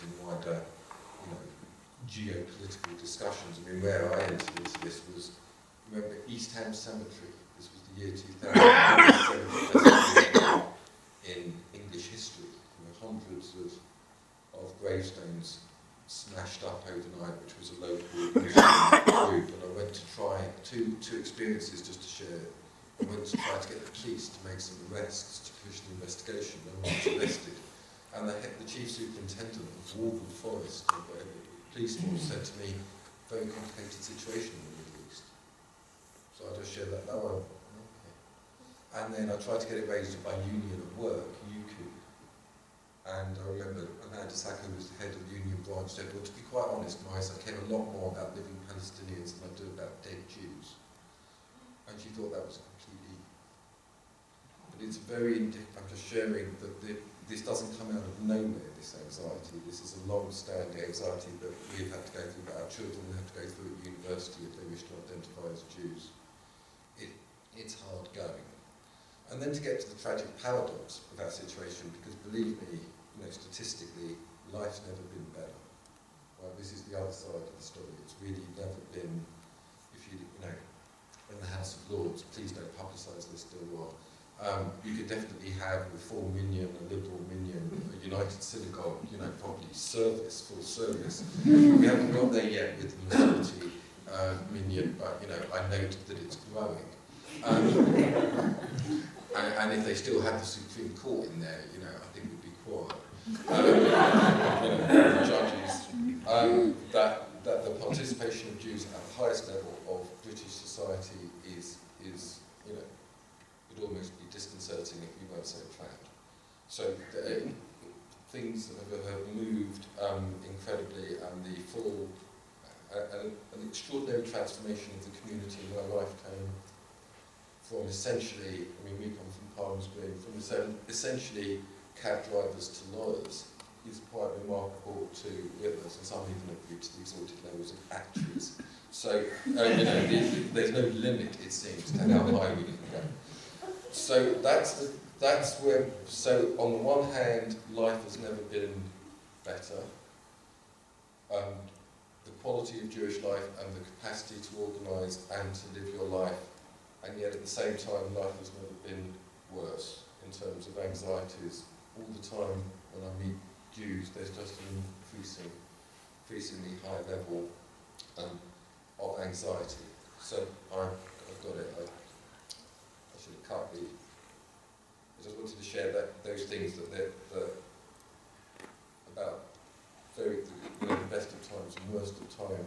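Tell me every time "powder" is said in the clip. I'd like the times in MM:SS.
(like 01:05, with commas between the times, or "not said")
not said.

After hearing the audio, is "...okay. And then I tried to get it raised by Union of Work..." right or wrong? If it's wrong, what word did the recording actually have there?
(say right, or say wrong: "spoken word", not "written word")
right.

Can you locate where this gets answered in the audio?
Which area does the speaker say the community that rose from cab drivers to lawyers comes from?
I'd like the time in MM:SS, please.
02:09.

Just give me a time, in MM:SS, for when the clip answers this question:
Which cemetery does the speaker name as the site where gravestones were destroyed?
00:06.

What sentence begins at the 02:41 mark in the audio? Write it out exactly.
All the time when I meet Jews, there's just an increasing, increasingly high level um, of anxiety.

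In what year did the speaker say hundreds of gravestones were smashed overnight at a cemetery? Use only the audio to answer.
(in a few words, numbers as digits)
2000.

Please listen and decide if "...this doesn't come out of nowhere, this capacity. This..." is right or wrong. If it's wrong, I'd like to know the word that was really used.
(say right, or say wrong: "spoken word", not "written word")
wrong: "anxiety", not "capacity".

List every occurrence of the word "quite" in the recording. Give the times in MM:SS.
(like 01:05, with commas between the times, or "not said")
00:46, 02:14.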